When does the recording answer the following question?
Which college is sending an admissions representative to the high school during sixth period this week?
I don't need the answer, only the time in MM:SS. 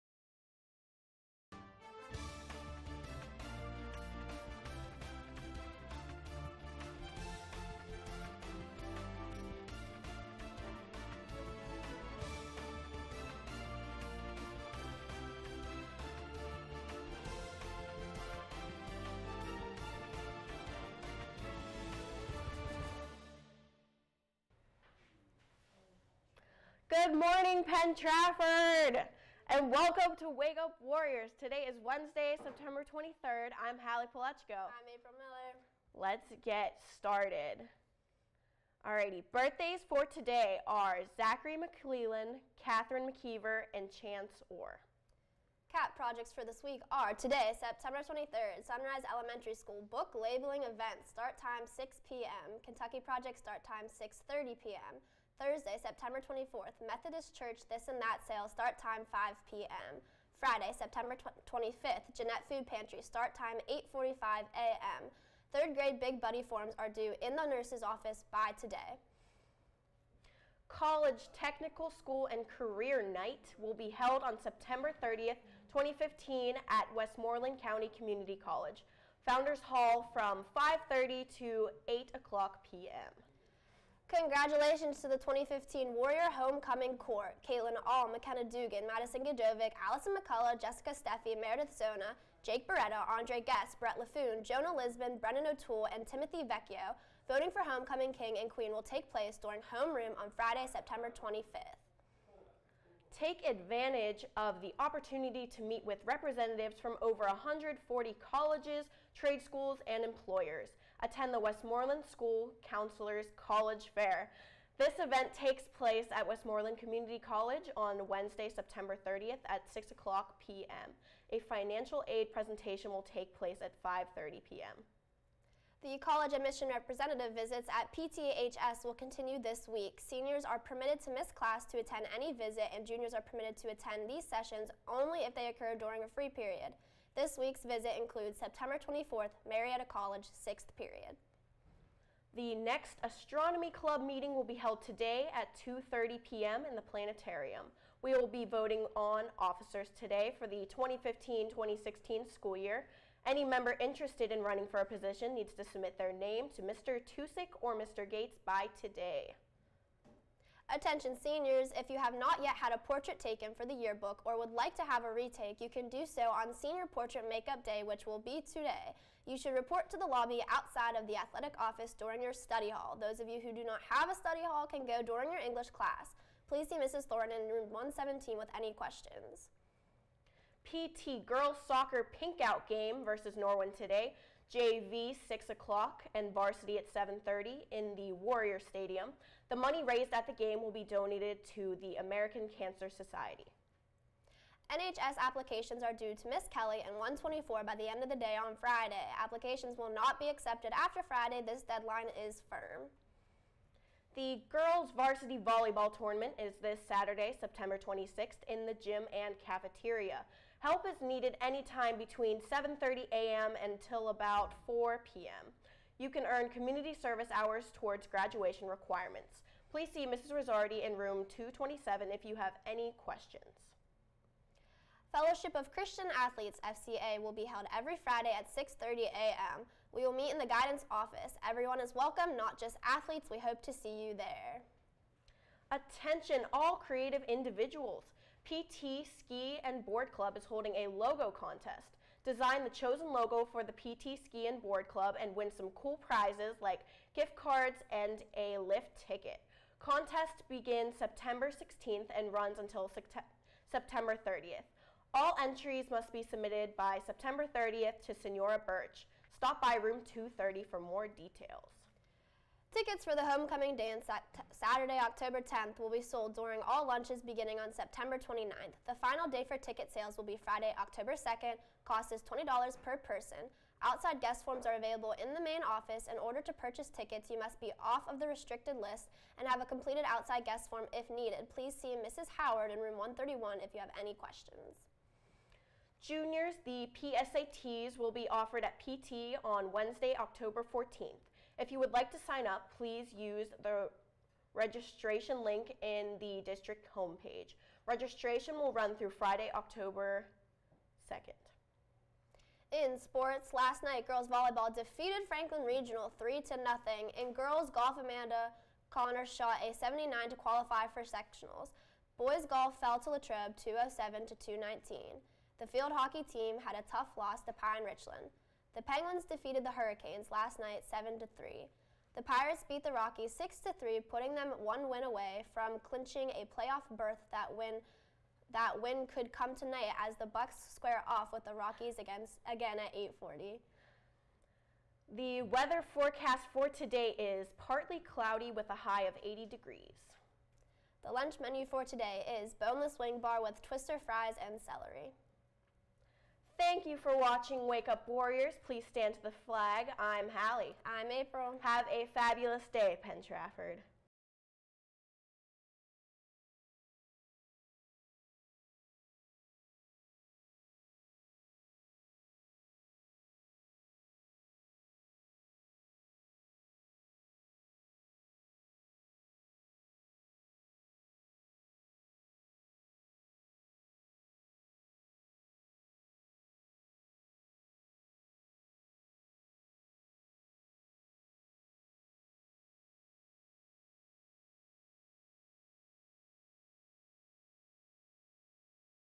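02:19.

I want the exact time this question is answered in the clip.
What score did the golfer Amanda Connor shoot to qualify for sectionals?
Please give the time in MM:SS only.
05:09.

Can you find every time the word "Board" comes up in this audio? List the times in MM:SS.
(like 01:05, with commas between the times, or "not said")
03:59, 04:04.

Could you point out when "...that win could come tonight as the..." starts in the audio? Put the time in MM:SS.
05:28.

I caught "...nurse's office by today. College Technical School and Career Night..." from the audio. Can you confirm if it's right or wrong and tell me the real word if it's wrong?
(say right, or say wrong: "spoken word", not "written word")
right.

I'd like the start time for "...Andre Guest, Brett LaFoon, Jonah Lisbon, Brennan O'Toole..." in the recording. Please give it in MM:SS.
01:33.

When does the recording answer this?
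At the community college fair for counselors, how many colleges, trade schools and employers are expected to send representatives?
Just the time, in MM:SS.
01:47.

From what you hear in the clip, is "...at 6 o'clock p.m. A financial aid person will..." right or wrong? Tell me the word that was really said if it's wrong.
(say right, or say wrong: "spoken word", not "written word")
wrong: "presentation", not "person".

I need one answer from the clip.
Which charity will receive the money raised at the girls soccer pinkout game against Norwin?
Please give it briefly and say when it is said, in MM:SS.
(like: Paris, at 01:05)
American Cancer Society, at 03:11.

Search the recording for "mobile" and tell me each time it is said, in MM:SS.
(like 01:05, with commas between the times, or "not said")
not said.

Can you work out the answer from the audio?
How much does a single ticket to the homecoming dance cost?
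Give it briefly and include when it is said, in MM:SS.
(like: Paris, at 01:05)
$20, at 04:32.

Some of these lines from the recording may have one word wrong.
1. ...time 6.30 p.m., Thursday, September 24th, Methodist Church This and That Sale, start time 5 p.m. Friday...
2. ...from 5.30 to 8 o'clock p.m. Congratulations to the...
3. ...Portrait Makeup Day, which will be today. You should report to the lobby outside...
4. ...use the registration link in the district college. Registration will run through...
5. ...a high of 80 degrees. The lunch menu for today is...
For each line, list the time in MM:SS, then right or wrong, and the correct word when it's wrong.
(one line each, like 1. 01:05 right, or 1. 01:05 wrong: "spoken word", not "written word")
1. 00:53 right
2. 01:20 right
3. 02:46 right
4. 04:53 wrong: "homepage", not "college"
5. 05:38 right.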